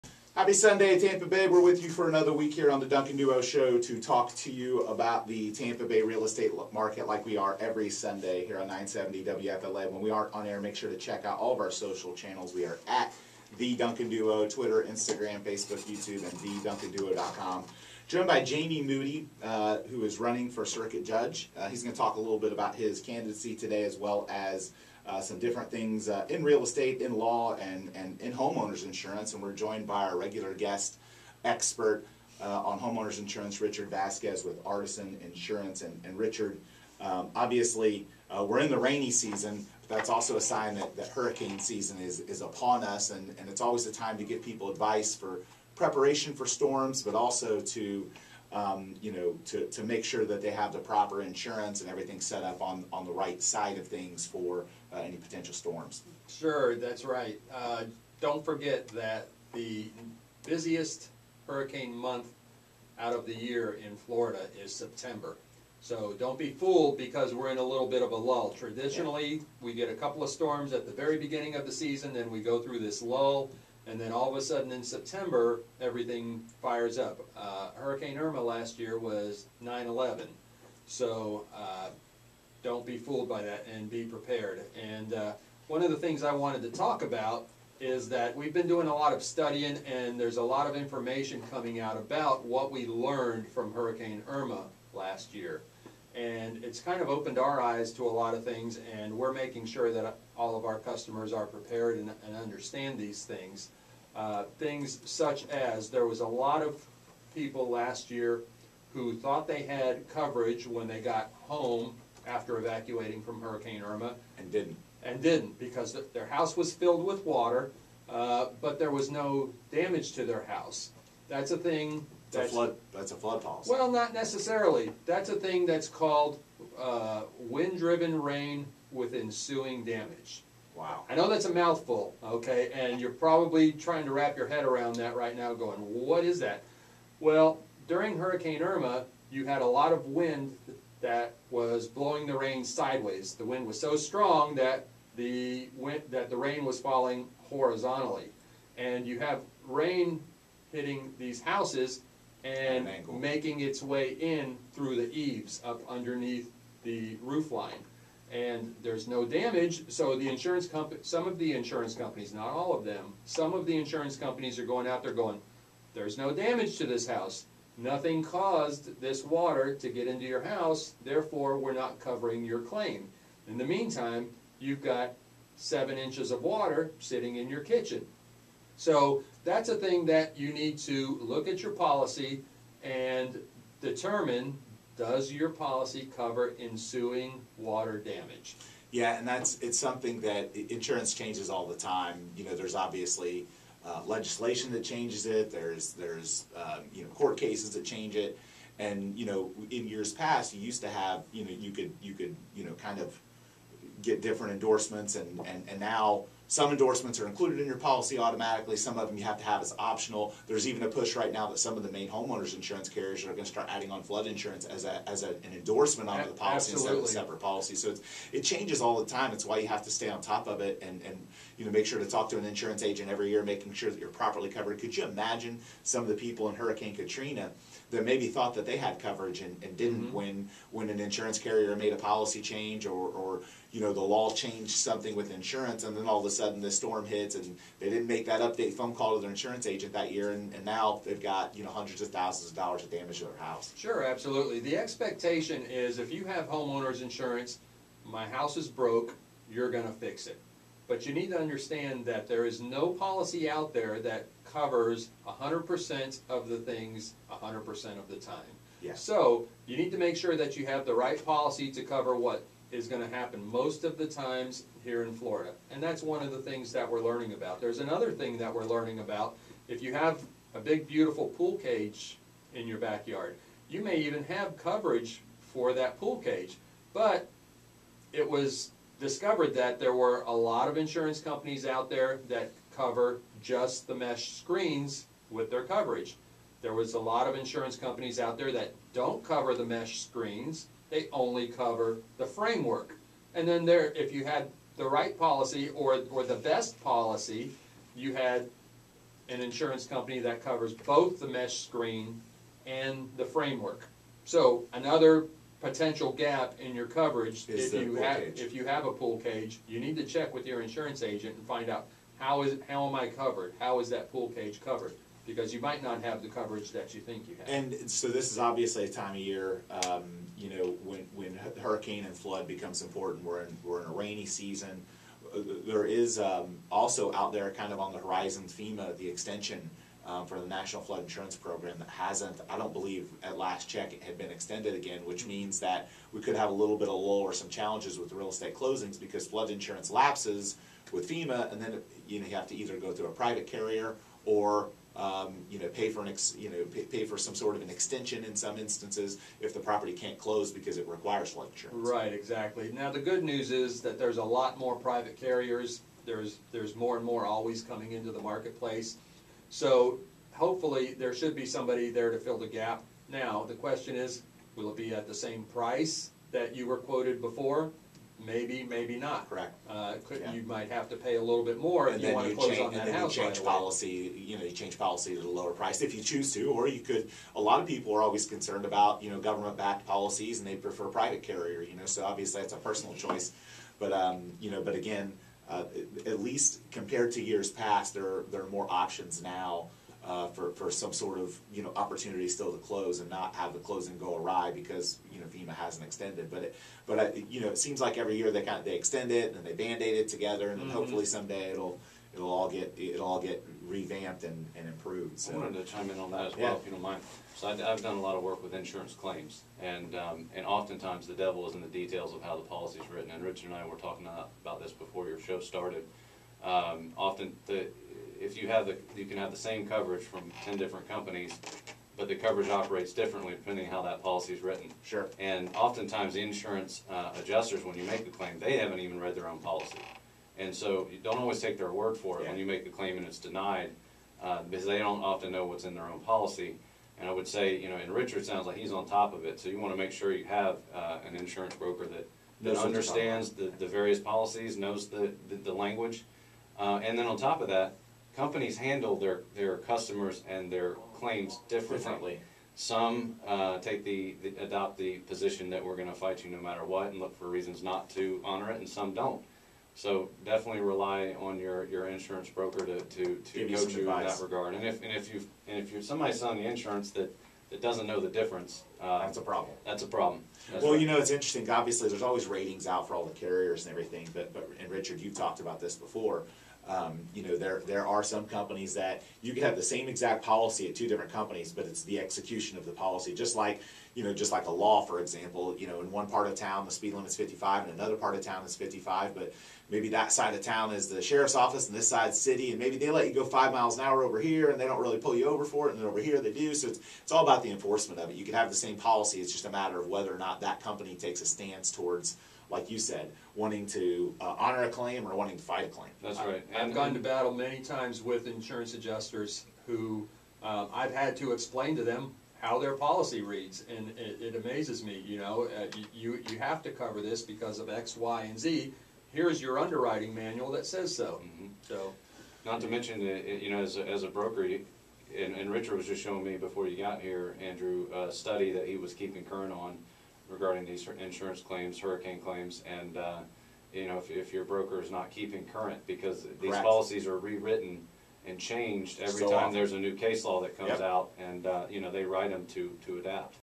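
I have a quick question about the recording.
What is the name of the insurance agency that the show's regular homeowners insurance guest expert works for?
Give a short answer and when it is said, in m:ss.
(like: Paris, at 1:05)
Artisan Insurance, at 0:34.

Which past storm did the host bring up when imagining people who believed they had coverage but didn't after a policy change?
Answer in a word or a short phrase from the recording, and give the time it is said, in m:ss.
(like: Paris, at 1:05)
Hurricane Katrina, at 3:46.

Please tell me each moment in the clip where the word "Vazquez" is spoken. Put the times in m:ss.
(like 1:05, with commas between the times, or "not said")
0:33.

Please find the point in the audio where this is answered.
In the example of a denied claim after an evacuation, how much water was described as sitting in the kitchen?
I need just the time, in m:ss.
2:55.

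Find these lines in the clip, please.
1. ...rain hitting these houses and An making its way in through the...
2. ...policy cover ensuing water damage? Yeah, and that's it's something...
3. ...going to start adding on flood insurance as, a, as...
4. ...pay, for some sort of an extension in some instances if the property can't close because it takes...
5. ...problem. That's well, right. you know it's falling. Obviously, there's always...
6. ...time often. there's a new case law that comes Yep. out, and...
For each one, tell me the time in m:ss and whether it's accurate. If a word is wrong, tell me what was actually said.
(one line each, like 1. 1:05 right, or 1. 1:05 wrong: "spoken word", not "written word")
1. 2:29 right
2. 3:05 right
3. 3:33 right
4. 5:46 wrong: "requires", not "takes"
5. 7:49 wrong: "interesting", not "falling"
6. 8:59 right.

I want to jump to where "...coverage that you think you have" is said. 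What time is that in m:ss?
5:16.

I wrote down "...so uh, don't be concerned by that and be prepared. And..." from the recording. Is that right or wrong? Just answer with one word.
wrong.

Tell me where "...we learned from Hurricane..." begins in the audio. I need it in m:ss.
1:32.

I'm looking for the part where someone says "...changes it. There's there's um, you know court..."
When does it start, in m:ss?
3:14.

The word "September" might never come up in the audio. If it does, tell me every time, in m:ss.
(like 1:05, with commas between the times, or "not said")
1:04, 1:14.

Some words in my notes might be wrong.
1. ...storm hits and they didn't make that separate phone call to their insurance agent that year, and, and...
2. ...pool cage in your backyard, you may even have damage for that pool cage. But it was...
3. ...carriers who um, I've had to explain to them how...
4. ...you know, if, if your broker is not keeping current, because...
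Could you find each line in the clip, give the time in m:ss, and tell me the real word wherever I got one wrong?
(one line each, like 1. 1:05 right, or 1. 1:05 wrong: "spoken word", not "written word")
1. 3:56 wrong: "update", not "separate"
2. 4:31 wrong: "coverage", not "damage"
3. 8:28 wrong: "adjusters", not "carriers"
4. 8:53 right.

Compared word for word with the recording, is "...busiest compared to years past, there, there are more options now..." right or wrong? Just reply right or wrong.
wrong.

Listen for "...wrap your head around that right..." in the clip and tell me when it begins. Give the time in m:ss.
2:14.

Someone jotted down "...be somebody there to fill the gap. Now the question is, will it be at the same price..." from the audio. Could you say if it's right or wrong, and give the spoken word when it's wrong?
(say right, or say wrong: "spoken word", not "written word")
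right.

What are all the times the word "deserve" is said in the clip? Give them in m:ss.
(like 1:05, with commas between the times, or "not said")
not said.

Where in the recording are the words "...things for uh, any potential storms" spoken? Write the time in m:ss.
0:53.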